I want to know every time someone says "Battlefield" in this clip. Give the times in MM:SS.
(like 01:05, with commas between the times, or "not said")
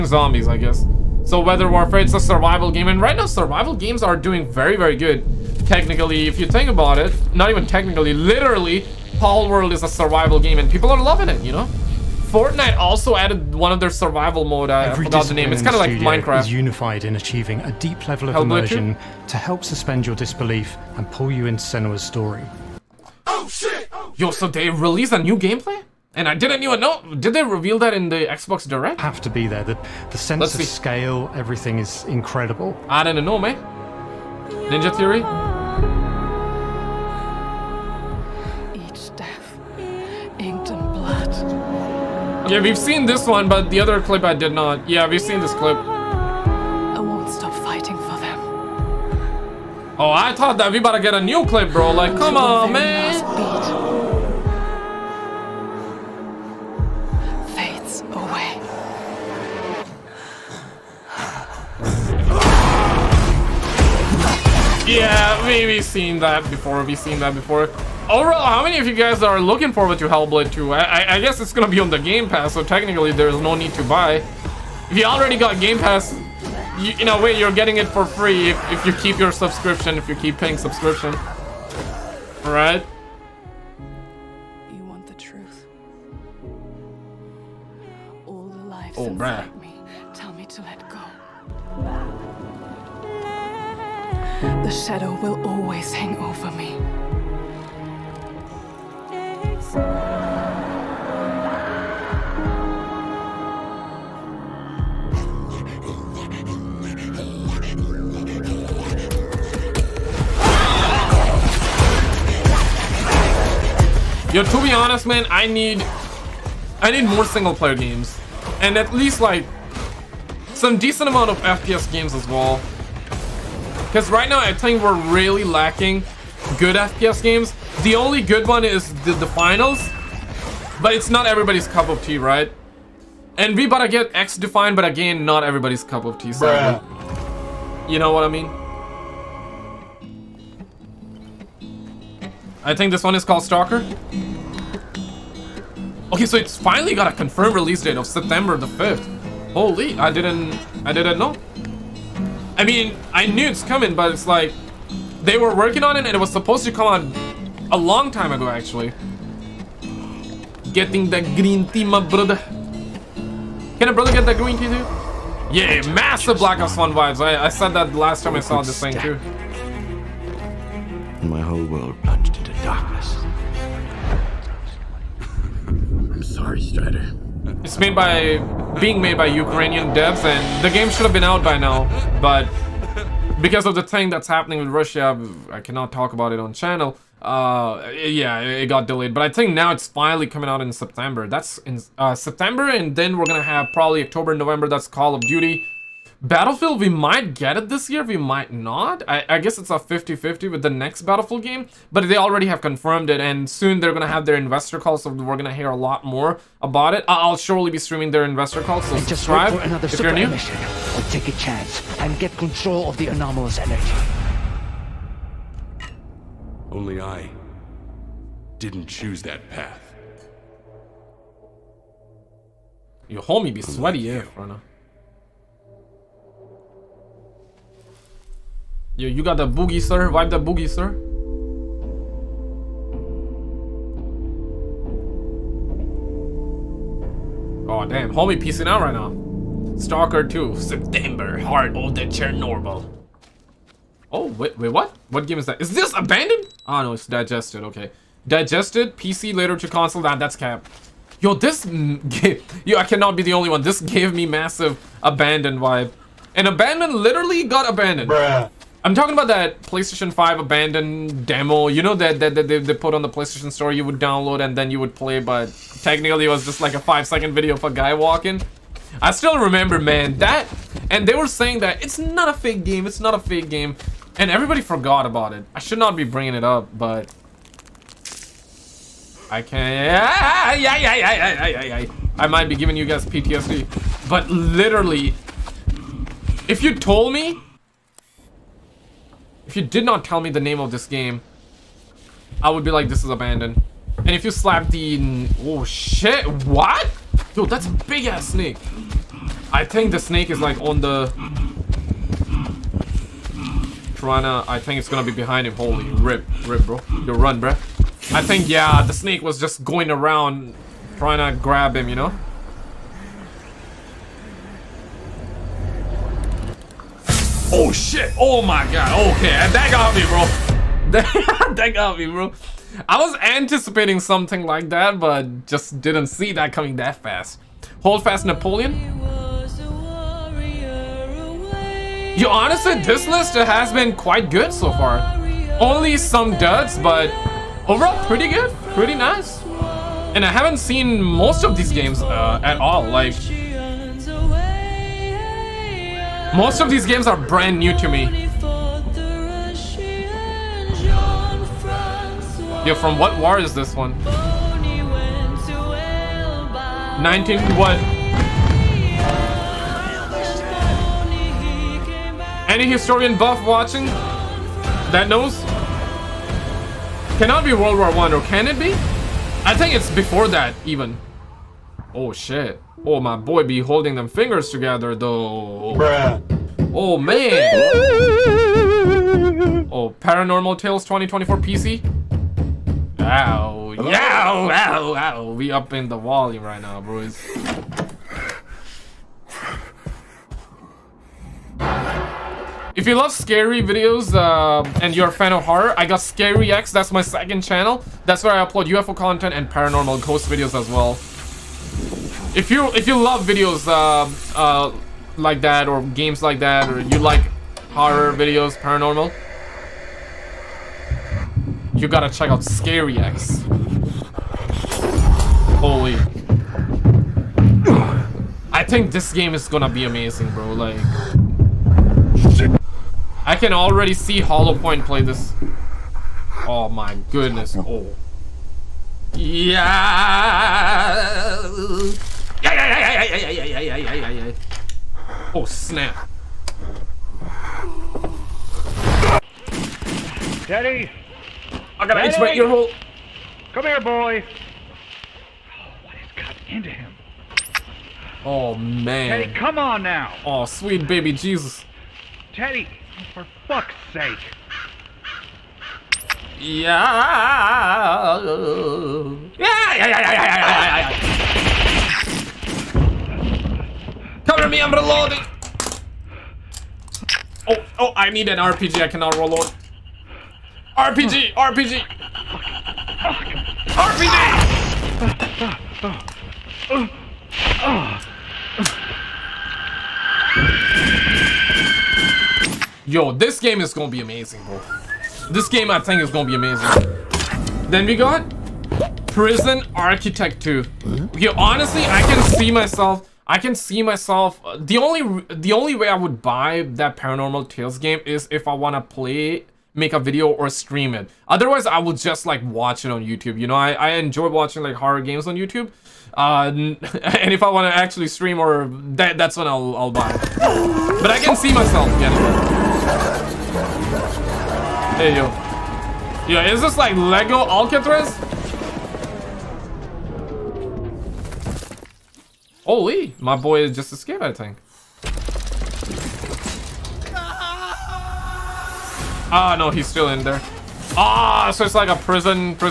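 03:16, 03:21.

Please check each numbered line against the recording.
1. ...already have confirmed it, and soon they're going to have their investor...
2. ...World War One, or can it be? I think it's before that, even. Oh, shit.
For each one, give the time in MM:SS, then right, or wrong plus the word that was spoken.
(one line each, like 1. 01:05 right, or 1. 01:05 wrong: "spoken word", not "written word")
1. 03:22 right
2. 06:07 right.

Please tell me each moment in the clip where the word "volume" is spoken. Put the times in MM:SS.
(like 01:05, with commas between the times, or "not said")
06:25.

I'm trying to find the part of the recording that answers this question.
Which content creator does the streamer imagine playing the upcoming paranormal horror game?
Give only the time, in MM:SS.
07:04.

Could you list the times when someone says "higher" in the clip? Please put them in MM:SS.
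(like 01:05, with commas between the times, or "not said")
not said.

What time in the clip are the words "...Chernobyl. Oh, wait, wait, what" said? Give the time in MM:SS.
04:02.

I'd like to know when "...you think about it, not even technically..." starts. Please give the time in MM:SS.
00:06.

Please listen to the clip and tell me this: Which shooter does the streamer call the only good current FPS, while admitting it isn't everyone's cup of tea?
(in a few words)
The Finals.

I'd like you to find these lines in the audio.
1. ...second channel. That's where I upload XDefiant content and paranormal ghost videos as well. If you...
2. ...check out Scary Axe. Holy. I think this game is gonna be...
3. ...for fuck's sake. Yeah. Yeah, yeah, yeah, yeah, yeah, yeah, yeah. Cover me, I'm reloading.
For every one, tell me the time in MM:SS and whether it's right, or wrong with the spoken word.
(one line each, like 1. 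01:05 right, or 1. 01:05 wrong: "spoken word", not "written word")
1. 06:37 wrong: "UFO", not "XDefiant"
2. 06:52 right
3. 07:33 right.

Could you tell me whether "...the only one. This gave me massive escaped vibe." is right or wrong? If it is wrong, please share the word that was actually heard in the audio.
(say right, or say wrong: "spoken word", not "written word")
wrong: "abandoned", not "escaped".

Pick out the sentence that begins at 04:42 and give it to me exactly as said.
I might be giving you guys PTSD.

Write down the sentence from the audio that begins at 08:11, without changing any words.
Yeah, honestly, I can see myself...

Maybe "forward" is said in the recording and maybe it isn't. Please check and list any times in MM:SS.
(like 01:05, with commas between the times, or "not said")
01:09.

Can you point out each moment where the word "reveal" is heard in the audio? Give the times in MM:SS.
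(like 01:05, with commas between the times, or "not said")
00:27.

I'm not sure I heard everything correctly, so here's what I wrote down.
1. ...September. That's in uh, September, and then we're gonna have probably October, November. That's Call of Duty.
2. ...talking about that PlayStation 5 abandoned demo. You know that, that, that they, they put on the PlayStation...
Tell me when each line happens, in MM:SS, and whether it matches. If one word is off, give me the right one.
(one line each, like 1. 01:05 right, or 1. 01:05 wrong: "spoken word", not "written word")
1. 03:10 right
2. 04:18 right.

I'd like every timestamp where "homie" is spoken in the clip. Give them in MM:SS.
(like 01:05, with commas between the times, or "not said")
03:43, 03:58.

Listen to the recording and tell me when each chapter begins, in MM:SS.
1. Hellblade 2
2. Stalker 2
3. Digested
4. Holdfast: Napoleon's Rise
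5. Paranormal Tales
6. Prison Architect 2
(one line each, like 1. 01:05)
1. 01:12
2. 02:52
3. 04:57
4. 06:41
5. 07:56
6. 08:35.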